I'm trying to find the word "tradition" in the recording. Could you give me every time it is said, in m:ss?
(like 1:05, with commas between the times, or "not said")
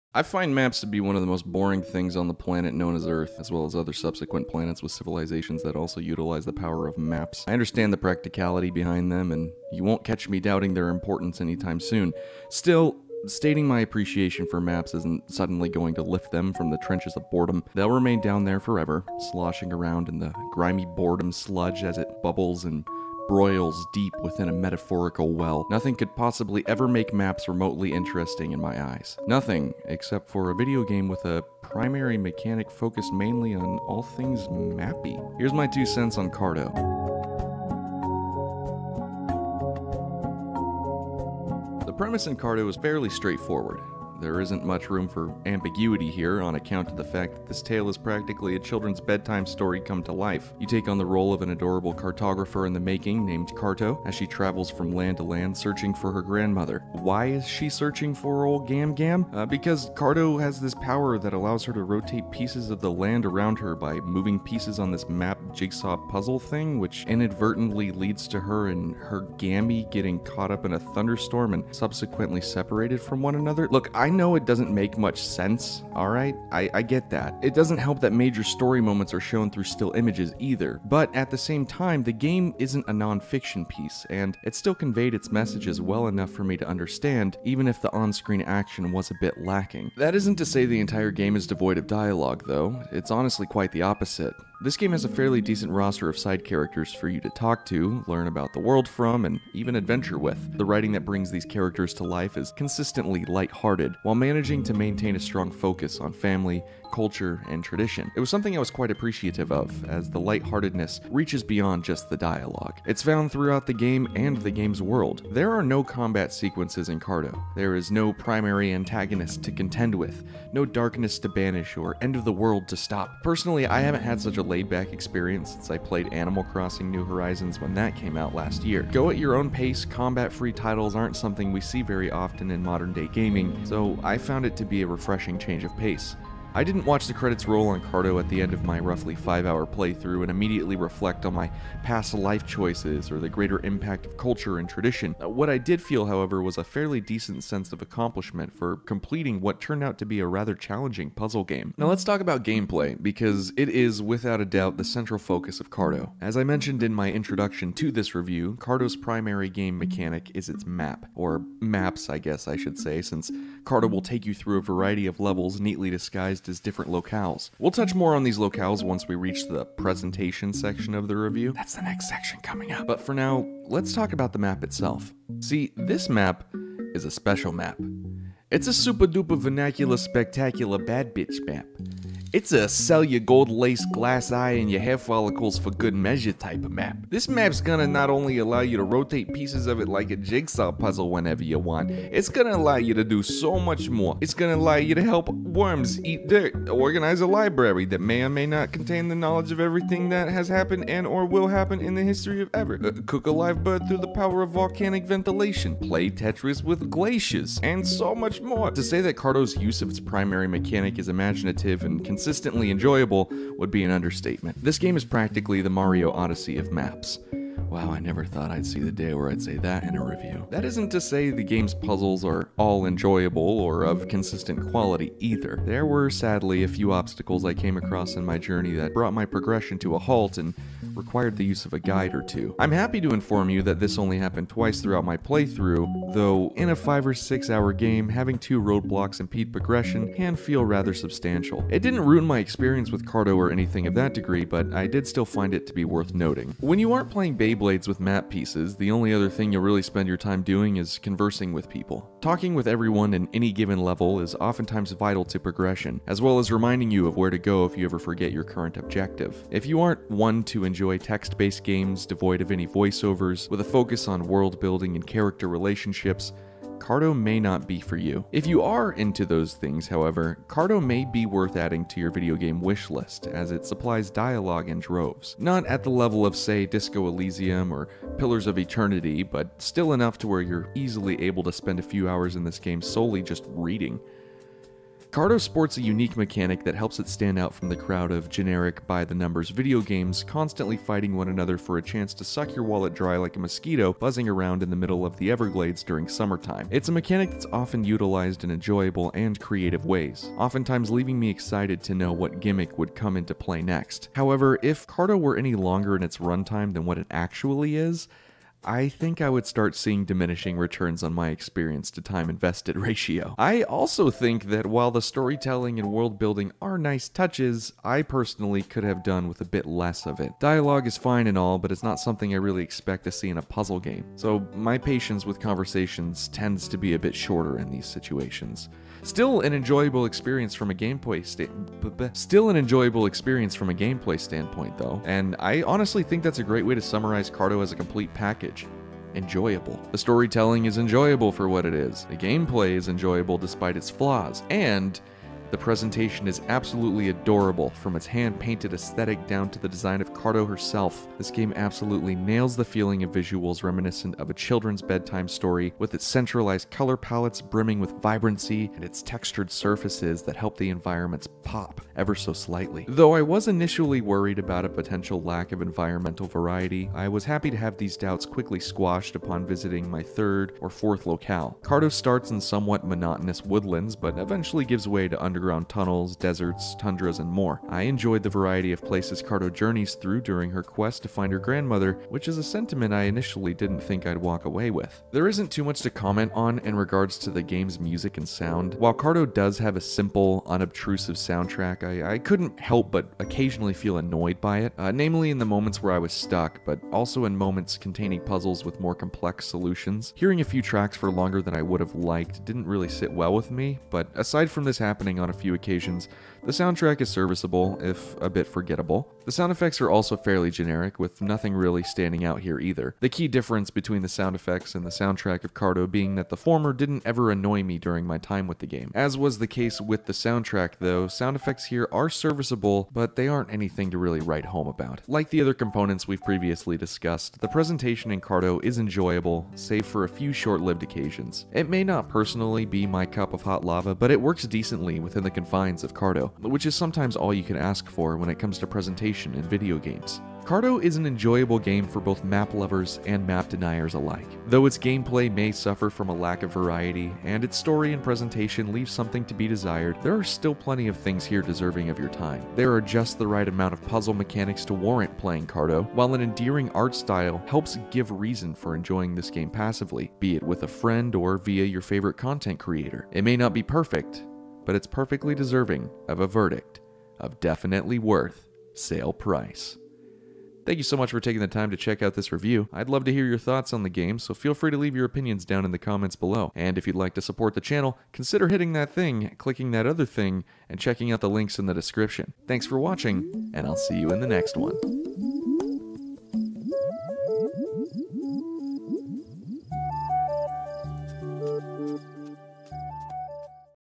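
1:47, 2:24.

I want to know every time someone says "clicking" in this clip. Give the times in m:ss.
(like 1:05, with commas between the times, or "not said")
7:59.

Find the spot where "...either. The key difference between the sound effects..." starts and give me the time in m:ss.
6:52.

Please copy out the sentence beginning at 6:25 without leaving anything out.
There isn't too much to comment on in regards to the game's music and sound.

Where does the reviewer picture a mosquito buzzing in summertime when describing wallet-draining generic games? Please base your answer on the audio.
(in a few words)
the Everglades.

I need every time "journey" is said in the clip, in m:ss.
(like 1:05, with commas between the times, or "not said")
3:48, 6:19.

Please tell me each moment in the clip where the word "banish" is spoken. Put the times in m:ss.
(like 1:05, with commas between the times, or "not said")
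2:01.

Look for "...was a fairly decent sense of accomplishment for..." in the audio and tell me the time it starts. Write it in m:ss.
2:26.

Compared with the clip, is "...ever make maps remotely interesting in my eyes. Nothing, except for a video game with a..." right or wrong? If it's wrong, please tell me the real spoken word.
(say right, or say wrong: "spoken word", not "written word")
right.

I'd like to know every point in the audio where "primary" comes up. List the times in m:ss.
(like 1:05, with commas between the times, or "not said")
0:31, 1:58, 2:38, 3:29.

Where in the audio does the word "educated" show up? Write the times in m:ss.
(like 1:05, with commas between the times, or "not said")
not said.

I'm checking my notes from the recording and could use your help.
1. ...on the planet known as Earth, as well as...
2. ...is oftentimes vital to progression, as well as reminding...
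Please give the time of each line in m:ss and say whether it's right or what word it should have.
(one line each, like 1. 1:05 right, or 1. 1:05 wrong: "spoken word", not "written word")
1. 0:02 right
2. 4:14 right.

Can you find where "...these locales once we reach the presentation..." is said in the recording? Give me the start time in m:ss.
2:48.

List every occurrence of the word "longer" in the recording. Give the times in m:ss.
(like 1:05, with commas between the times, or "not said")
5:05, 6:41.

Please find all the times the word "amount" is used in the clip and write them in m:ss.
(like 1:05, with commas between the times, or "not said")
7:33.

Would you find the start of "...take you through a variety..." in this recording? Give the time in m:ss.
2:44.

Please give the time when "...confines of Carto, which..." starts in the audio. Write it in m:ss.
7:15.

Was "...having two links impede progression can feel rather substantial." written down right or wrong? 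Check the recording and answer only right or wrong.
wrong.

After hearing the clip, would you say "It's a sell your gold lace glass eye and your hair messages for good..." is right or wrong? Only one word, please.
wrong.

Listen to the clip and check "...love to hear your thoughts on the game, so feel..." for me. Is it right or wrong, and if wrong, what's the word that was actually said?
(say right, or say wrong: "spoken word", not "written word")
right.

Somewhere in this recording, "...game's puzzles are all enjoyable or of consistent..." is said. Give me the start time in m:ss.
3:41.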